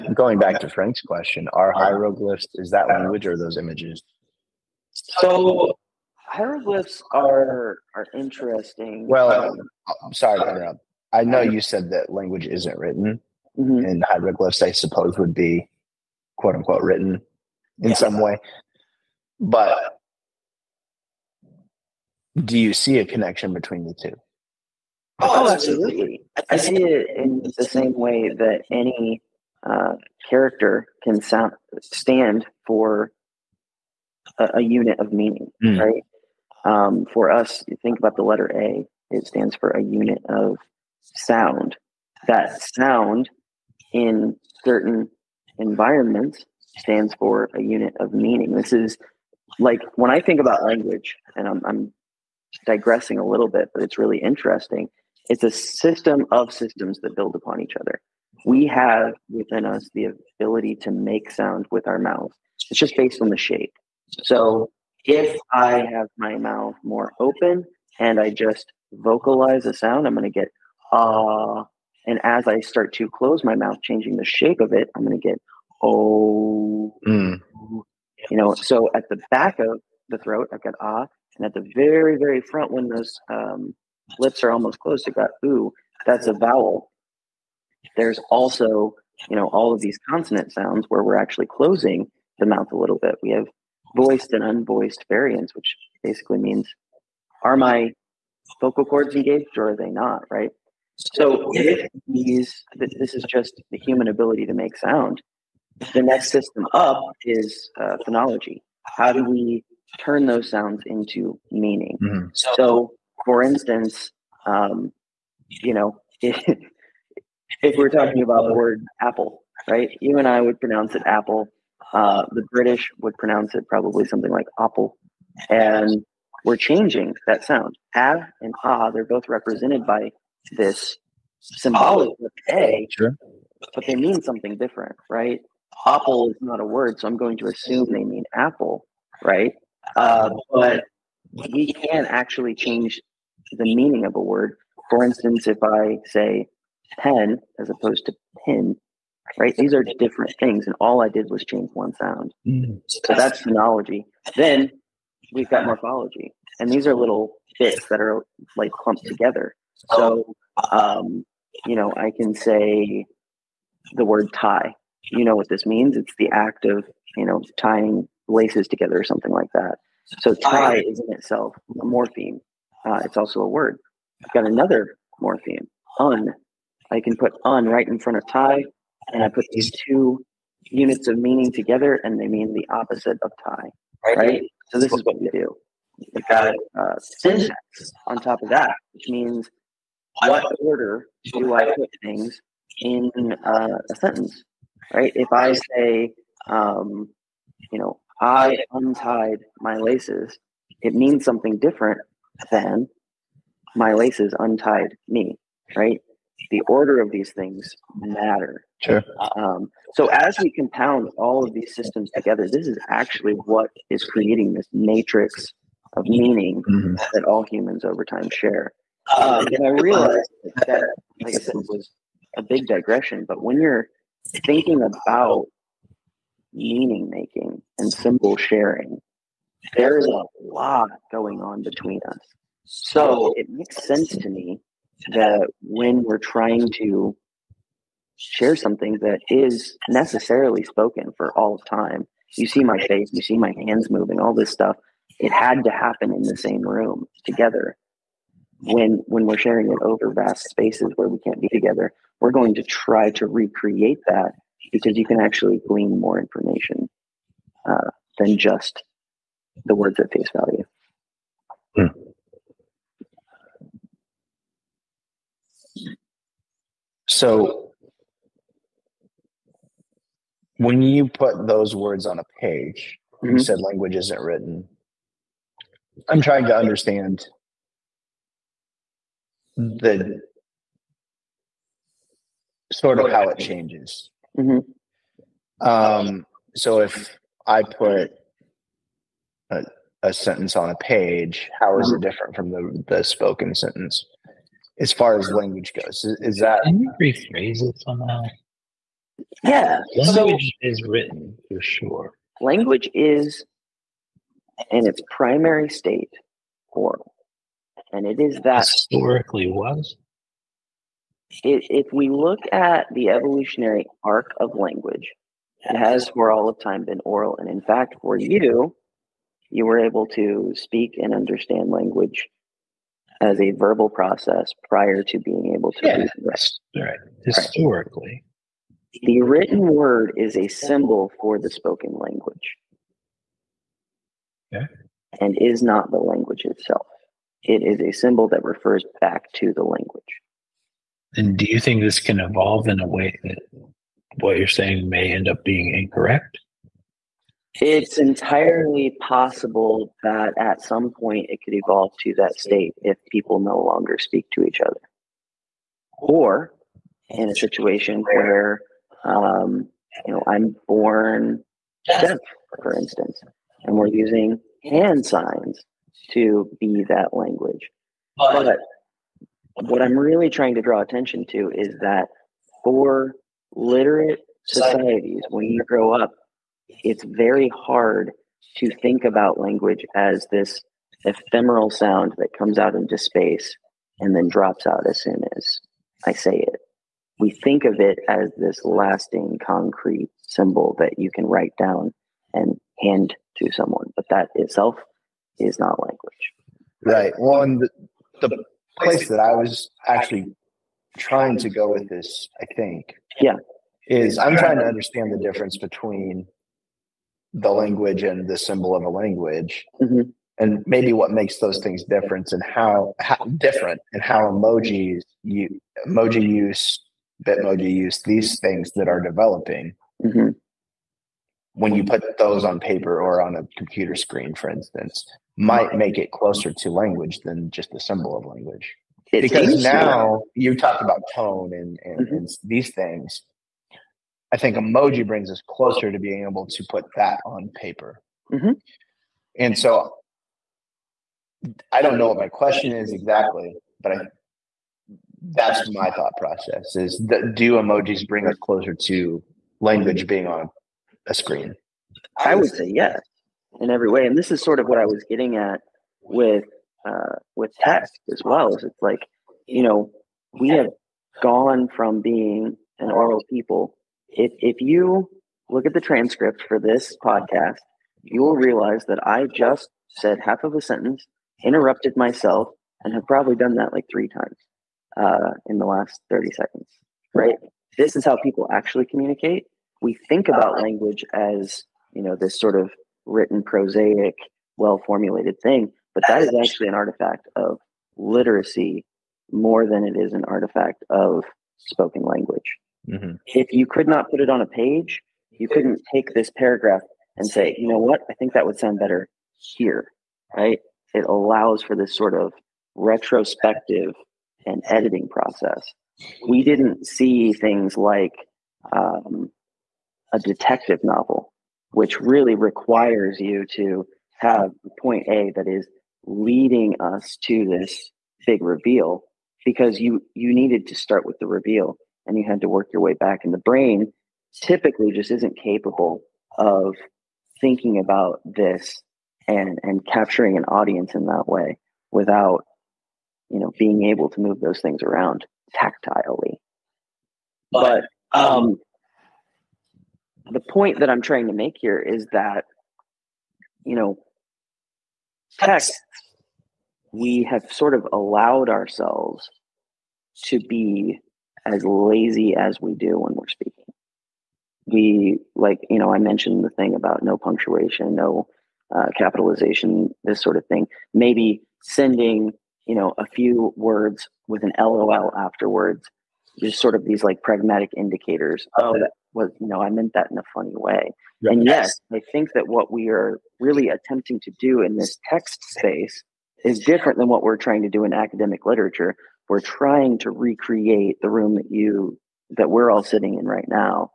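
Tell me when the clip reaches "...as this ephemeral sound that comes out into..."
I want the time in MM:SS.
06:19.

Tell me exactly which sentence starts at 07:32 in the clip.
I would say yes in every way.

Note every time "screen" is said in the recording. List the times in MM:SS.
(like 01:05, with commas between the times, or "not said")
07:03, 07:31.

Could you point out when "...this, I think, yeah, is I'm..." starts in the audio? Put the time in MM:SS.
06:41.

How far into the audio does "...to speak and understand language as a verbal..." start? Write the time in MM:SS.
05:20.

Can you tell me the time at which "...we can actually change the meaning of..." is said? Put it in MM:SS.
02:21.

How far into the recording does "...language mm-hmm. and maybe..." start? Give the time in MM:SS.
06:48.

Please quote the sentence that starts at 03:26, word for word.
The order of these things matter.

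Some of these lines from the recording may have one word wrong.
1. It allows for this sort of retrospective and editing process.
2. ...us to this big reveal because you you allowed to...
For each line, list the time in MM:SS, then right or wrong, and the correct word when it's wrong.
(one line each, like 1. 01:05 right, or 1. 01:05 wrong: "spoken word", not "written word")
1. 08:20 right
2. 08:36 wrong: "needed", not "allowed".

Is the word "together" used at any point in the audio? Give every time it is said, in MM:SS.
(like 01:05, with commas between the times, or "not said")
02:39, 02:48, 03:01, 03:32, 04:07, 04:11.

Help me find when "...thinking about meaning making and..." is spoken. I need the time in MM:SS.
03:44.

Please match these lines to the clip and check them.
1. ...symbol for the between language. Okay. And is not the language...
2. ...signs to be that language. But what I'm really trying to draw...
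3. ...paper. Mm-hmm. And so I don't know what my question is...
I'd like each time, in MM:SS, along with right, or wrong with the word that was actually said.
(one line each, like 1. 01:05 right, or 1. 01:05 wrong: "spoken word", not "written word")
1. 05:30 wrong: "spoken", not "between"
2. 06:05 right
3. 07:17 right.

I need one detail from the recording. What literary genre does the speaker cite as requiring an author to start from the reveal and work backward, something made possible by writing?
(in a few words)
detective novel.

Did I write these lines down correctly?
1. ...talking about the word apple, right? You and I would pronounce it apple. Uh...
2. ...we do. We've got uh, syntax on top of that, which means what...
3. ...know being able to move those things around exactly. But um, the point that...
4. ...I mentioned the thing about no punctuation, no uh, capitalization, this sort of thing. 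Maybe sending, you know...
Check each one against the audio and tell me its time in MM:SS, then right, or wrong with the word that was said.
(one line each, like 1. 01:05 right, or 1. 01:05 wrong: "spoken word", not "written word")
1. 01:57 right
2. 03:05 right
3. 08:53 wrong: "tactilely", not "exactly"
4. 09:15 right.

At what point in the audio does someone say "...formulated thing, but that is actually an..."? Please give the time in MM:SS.
08:04.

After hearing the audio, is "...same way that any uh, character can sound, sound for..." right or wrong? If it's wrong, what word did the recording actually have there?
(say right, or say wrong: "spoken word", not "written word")
wrong: "stand", not "sound".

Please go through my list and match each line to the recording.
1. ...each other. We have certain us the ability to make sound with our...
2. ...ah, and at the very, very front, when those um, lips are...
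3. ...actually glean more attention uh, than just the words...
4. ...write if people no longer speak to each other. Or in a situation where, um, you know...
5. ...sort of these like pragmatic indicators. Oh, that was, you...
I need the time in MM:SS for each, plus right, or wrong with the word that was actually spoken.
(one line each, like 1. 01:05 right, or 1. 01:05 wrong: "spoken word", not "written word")
1. 00:57 wrong: "within", not "certain"
2. 01:20 right
3. 04:15 wrong: "information", not "attention"
4. 05:52 wrong: "state", not "write"
5. 09:26 right.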